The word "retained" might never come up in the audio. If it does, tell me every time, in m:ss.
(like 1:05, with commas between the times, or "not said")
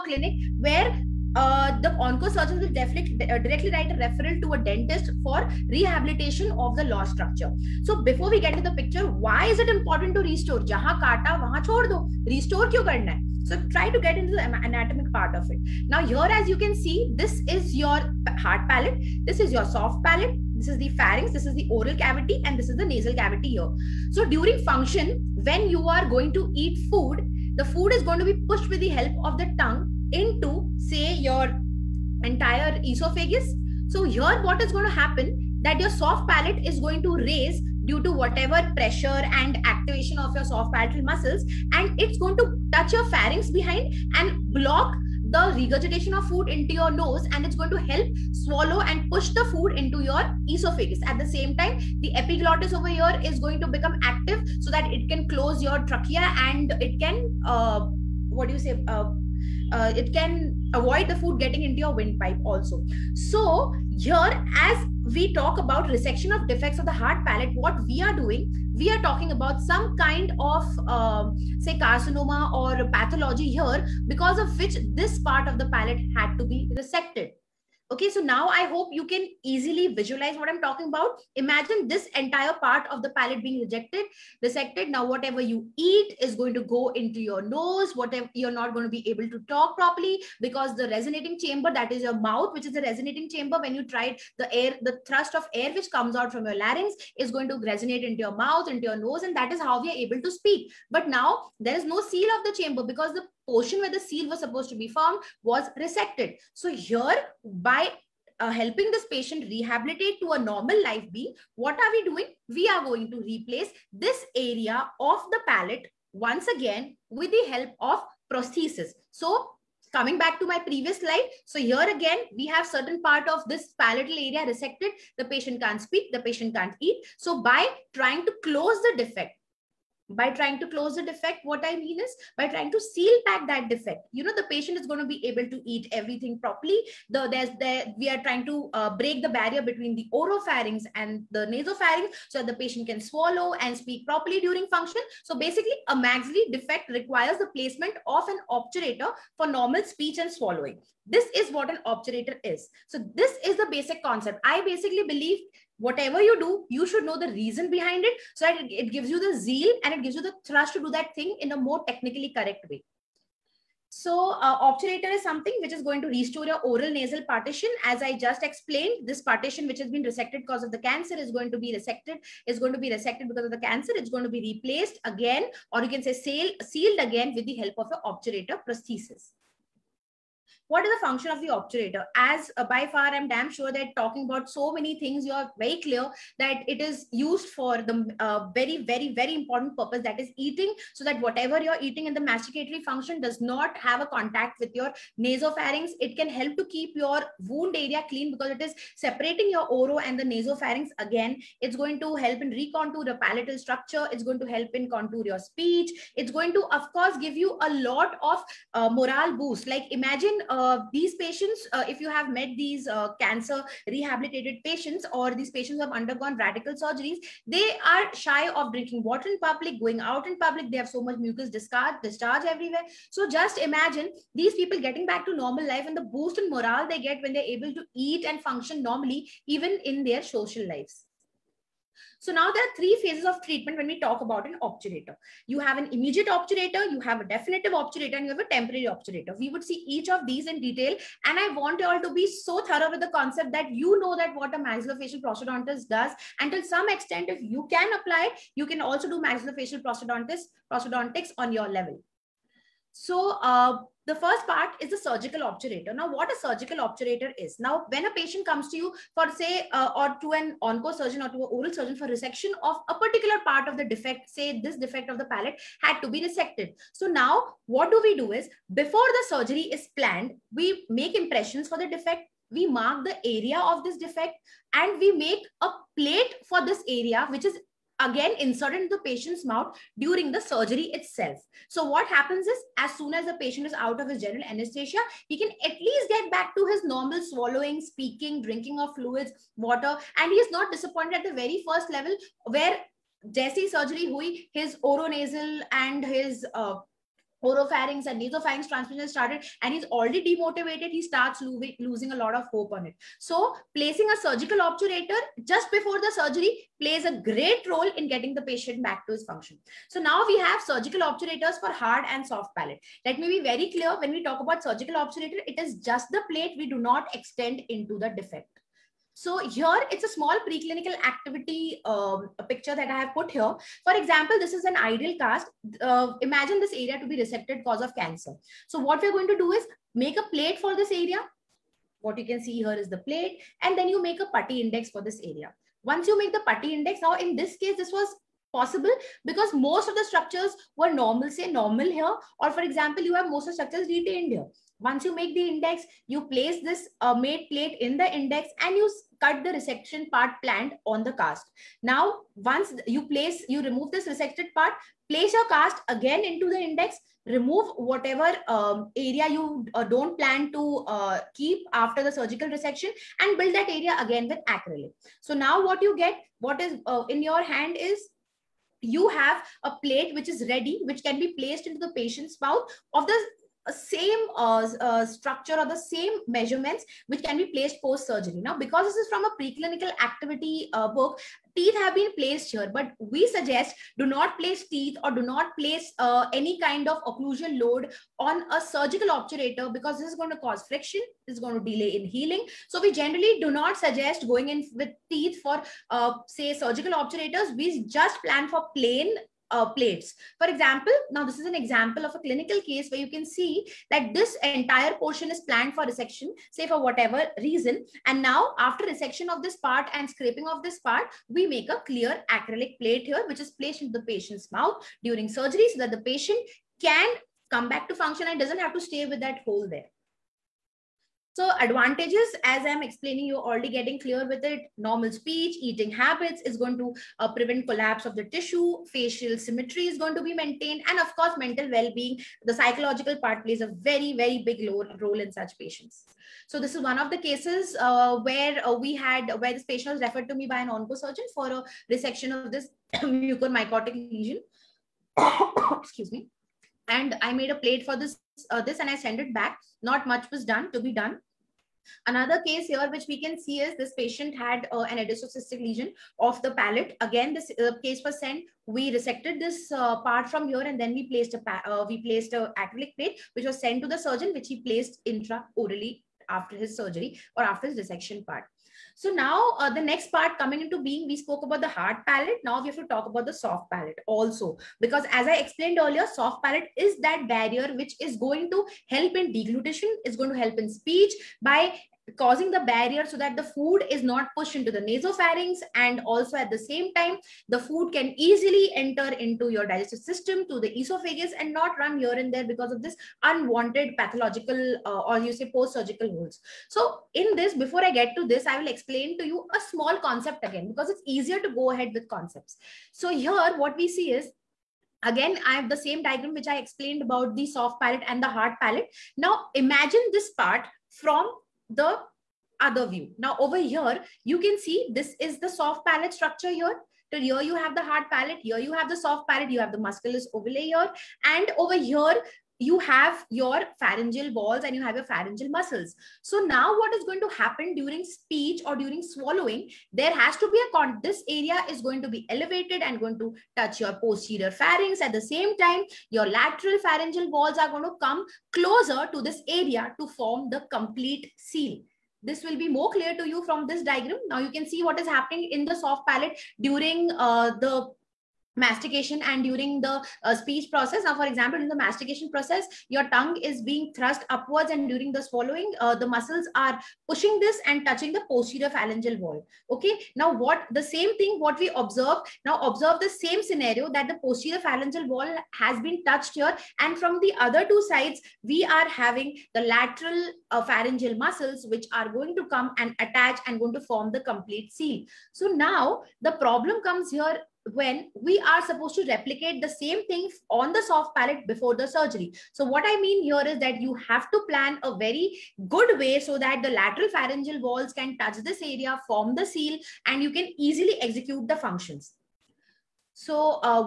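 5:43.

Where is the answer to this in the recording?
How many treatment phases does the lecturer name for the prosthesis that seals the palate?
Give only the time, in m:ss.
3:52.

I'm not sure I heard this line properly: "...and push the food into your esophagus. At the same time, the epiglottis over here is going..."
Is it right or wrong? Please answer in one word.
right.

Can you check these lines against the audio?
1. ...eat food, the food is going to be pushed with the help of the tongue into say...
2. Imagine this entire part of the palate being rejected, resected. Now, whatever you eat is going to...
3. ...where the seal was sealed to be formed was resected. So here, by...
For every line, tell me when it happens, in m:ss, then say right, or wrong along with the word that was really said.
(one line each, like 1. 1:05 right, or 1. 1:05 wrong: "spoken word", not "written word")
1. 0:26 right
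2. 1:21 right
3. 1:43 wrong: "supposed", not "sealed".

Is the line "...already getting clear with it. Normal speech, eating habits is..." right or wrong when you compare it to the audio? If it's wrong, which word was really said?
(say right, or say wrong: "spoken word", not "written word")
right.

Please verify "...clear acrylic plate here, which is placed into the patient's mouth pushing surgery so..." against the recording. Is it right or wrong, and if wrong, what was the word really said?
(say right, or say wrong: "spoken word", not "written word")
wrong: "during", not "pushing".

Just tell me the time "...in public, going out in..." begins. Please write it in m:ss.
3:39.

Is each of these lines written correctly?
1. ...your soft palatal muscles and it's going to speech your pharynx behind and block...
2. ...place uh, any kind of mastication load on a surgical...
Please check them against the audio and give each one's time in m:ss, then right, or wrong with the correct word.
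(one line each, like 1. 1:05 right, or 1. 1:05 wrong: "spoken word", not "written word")
1. 0:40 wrong: "touch", not "speech"
2. 6:25 wrong: "occlusion", not "mastication".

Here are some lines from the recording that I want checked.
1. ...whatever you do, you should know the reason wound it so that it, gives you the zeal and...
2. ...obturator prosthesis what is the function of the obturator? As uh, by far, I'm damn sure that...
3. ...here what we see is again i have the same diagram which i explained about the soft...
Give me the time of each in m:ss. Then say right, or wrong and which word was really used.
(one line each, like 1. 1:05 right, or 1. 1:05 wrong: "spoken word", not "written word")
1. 2:35 wrong: "behind", not "wound"
2. 2:58 right
3. 8:23 right.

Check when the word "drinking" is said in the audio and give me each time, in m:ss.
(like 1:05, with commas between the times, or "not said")
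3:38, 4:48.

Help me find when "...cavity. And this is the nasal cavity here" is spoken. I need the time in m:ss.
0:21.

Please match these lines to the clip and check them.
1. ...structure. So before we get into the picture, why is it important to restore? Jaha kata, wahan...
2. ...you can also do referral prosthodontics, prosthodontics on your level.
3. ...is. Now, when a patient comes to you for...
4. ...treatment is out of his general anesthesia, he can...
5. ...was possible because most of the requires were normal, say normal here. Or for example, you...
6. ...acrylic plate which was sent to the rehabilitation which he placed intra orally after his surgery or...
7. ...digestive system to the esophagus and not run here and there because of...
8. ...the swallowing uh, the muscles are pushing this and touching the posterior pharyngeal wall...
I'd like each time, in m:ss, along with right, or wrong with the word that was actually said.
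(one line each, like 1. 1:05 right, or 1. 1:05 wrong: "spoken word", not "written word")
1. 0:07 right
2. 4:08 wrong: "maxillofacial", not "referral"
3. 4:17 right
4. 4:43 wrong: "patient", not "treatment"
5. 5:37 wrong: "structures", not "requires"
6. 7:42 wrong: "surgeon", not "rehabilitation"
7. 8:09 right
8. 9:15 right.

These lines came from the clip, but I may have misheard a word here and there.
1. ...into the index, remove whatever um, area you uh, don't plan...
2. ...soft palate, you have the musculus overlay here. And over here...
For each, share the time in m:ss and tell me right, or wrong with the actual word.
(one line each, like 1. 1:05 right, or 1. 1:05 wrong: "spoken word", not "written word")
1. 5:56 right
2. 8:38 right.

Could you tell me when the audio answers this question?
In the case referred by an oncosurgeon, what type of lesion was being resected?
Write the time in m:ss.
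7:22.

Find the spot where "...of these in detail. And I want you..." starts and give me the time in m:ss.
4:00.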